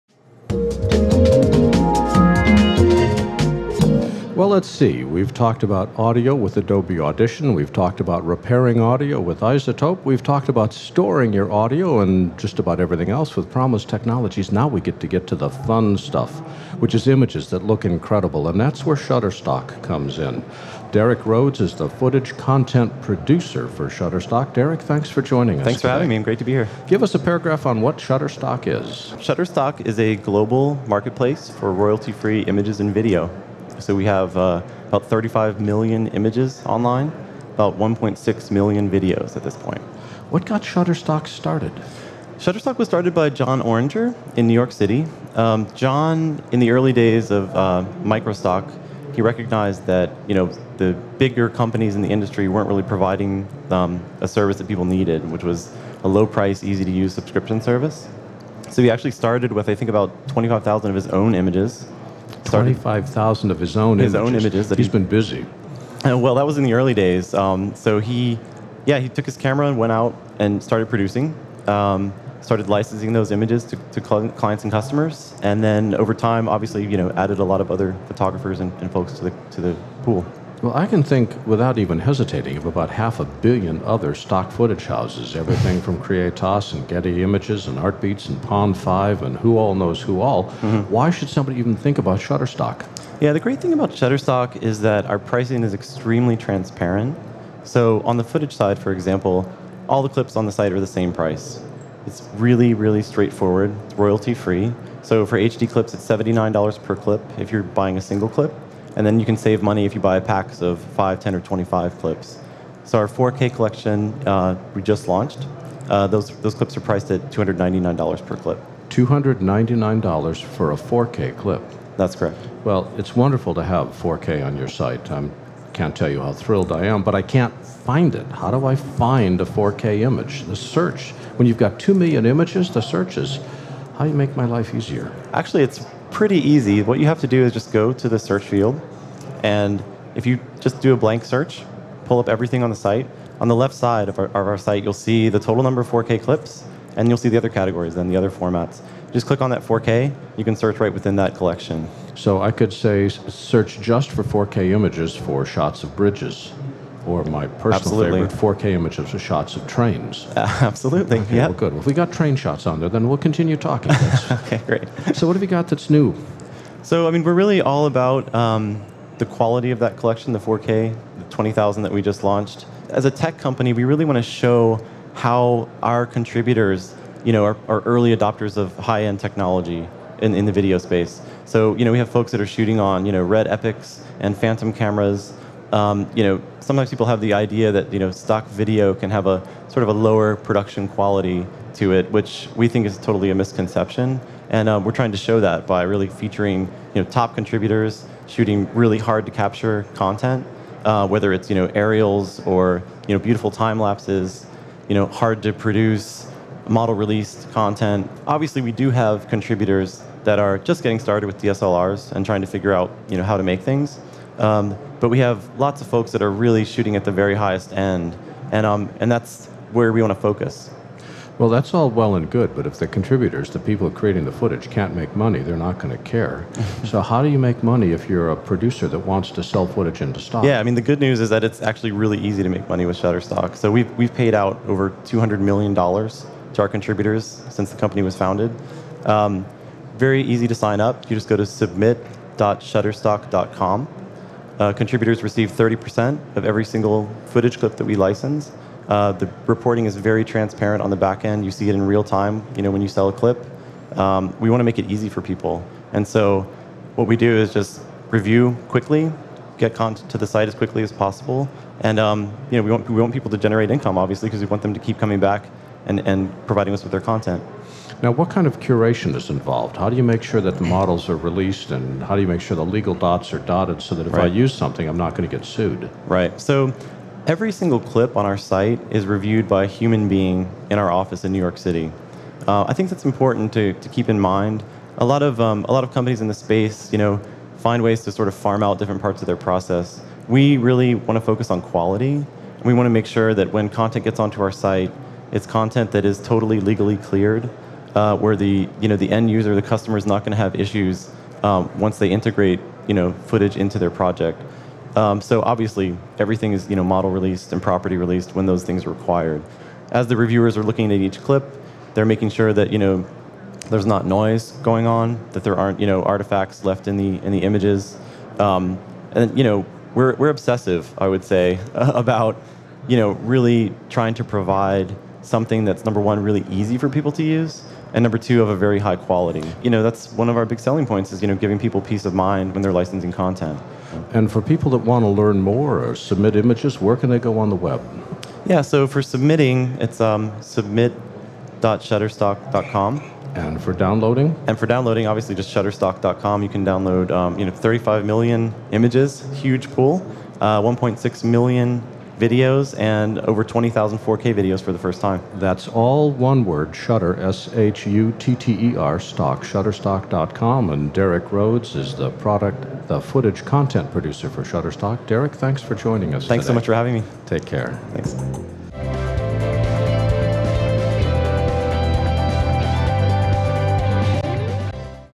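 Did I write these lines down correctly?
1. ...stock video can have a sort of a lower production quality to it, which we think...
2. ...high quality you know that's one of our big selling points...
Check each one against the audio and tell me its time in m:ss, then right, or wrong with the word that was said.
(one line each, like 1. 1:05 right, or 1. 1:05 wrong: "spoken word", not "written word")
1. 3:08 right
2. 5:28 right.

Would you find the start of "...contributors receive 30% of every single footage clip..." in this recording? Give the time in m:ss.
4:04.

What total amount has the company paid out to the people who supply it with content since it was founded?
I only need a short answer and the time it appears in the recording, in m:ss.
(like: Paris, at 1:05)
$200 million, at 3:55.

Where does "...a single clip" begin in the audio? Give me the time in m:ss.
1:47.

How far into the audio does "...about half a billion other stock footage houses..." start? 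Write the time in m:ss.
1:22.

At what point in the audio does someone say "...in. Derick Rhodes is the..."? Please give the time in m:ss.
0:20.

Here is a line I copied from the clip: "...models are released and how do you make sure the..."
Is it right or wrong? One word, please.
right.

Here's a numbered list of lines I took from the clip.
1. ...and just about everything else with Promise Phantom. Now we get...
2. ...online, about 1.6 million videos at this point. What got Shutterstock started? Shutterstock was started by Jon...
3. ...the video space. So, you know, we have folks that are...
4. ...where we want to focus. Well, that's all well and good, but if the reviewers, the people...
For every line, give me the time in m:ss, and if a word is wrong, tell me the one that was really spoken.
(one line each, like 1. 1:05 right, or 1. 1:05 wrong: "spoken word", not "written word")
1. 0:11 wrong: "Technologies", not "Phantom"
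2. 0:36 right
3. 3:00 right
4. 3:39 wrong: "contributors", not "reviewers".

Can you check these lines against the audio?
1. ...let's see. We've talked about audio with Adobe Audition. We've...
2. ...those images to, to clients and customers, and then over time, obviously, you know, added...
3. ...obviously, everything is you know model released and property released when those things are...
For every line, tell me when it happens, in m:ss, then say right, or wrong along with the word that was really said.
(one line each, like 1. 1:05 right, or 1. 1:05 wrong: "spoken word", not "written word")
1. 0:04 right
2. 1:13 right
3. 5:05 right.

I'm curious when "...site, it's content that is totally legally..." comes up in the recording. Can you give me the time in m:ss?
4:54.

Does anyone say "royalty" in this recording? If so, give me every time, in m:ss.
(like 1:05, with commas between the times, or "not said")
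0:31, 1:43.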